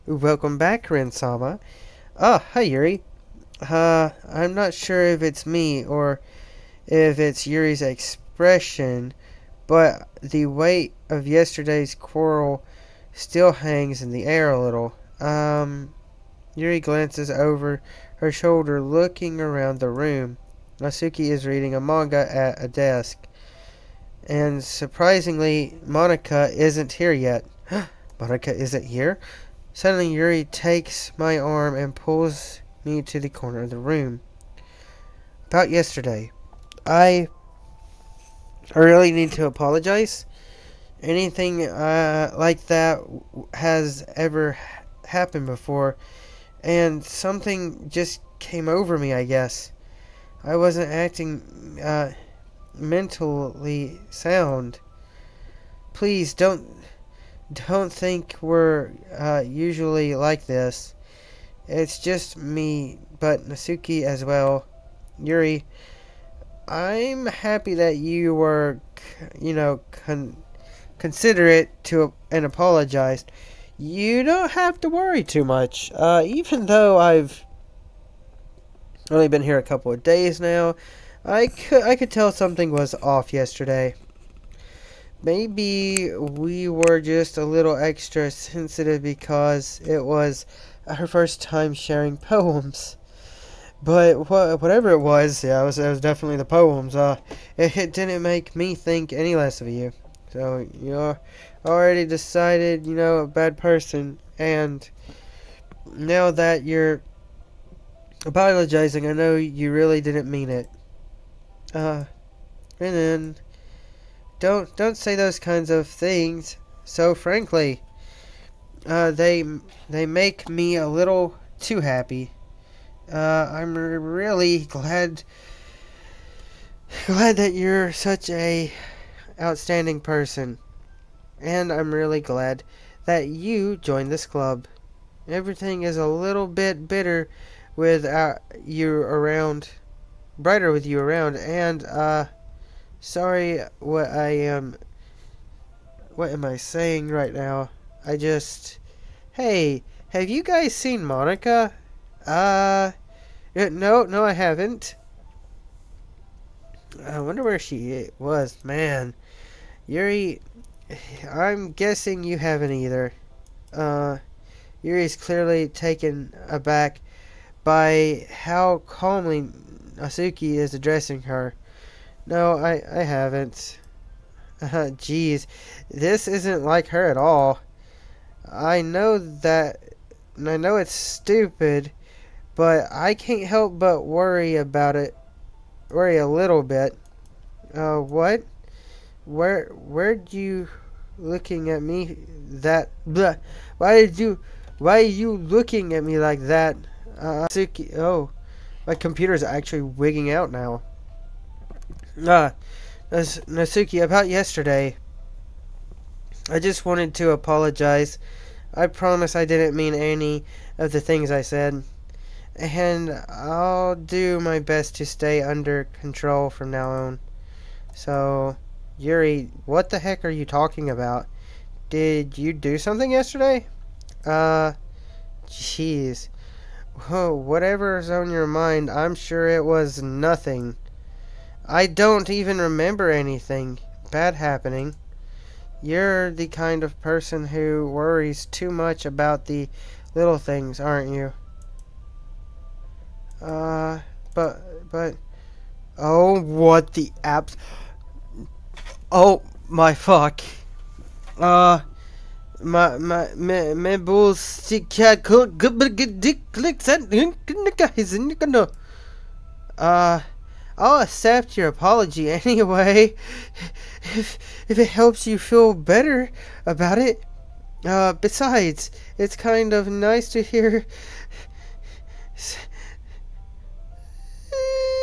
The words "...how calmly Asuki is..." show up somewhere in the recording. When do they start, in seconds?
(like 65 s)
168 s.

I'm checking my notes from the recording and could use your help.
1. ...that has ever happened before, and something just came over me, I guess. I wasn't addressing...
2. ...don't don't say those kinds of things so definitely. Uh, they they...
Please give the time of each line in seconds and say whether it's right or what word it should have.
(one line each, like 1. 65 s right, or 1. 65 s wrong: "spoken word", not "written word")
1. 42 s wrong: "acting", not "addressing"
2. 114 s wrong: "frankly", not "definitely".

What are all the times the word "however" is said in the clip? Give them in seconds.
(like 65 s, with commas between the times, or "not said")
not said.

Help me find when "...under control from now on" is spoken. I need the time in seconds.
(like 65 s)
215 s.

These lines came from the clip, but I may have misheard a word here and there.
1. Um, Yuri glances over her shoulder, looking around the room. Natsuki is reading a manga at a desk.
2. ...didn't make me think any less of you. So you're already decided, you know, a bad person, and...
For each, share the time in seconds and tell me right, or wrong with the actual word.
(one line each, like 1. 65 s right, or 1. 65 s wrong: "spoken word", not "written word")
1. 15 s right
2. 97 s right.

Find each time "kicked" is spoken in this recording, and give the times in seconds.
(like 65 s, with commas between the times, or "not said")
not said.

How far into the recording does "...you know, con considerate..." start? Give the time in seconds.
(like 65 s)
69 s.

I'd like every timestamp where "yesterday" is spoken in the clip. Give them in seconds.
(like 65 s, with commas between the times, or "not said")
11 s, 35 s, 83 s, 204 s, 223 s.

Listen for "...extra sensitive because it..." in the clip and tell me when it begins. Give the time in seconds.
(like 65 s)
87 s.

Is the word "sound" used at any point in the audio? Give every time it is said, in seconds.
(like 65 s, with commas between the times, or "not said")
54 s.